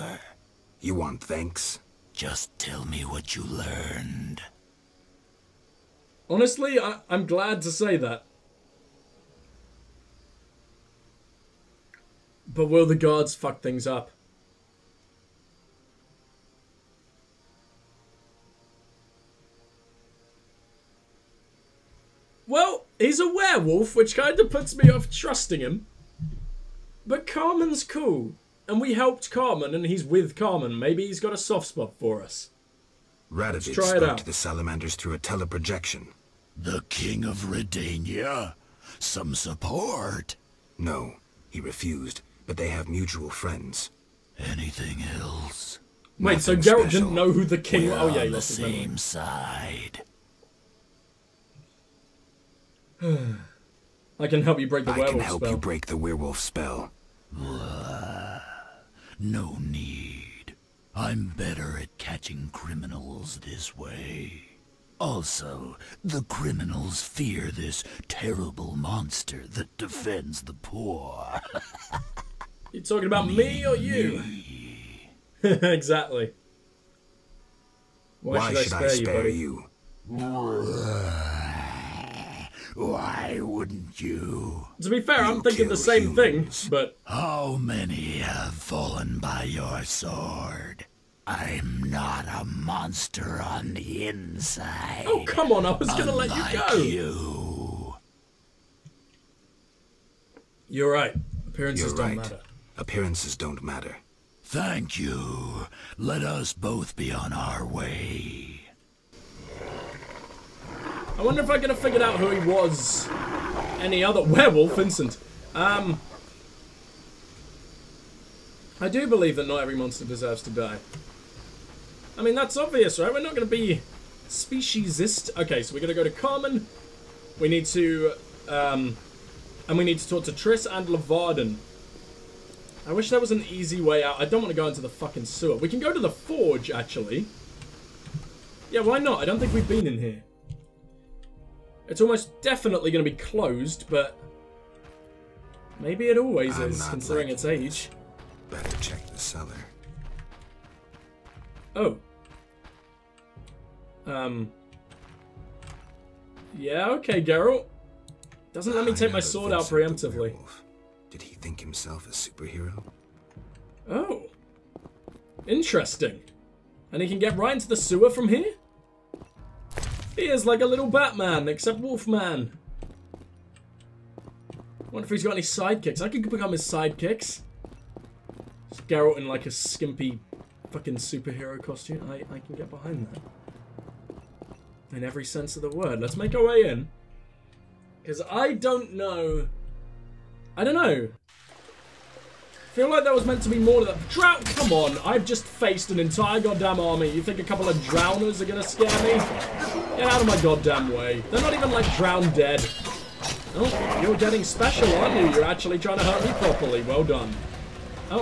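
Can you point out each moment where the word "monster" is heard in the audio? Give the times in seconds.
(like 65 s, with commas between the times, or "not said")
68 s, 92 s, 119 s.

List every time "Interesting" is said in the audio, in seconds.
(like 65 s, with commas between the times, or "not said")
165 s.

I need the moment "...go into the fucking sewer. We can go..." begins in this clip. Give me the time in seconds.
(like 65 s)
134 s.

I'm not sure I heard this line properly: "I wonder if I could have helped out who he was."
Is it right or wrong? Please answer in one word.
wrong.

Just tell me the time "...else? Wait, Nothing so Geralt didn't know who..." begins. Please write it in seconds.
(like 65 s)
45 s.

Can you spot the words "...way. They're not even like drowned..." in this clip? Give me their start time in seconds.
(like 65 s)
200 s.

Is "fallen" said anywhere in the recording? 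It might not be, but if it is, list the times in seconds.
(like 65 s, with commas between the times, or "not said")
88 s.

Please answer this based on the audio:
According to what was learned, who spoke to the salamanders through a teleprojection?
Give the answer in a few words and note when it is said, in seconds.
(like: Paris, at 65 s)
Radovid, at 33 s.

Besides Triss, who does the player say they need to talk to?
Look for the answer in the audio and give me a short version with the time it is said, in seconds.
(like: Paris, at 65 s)
Leuvaarden, at 130 s.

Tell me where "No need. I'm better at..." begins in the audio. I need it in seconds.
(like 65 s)
59 s.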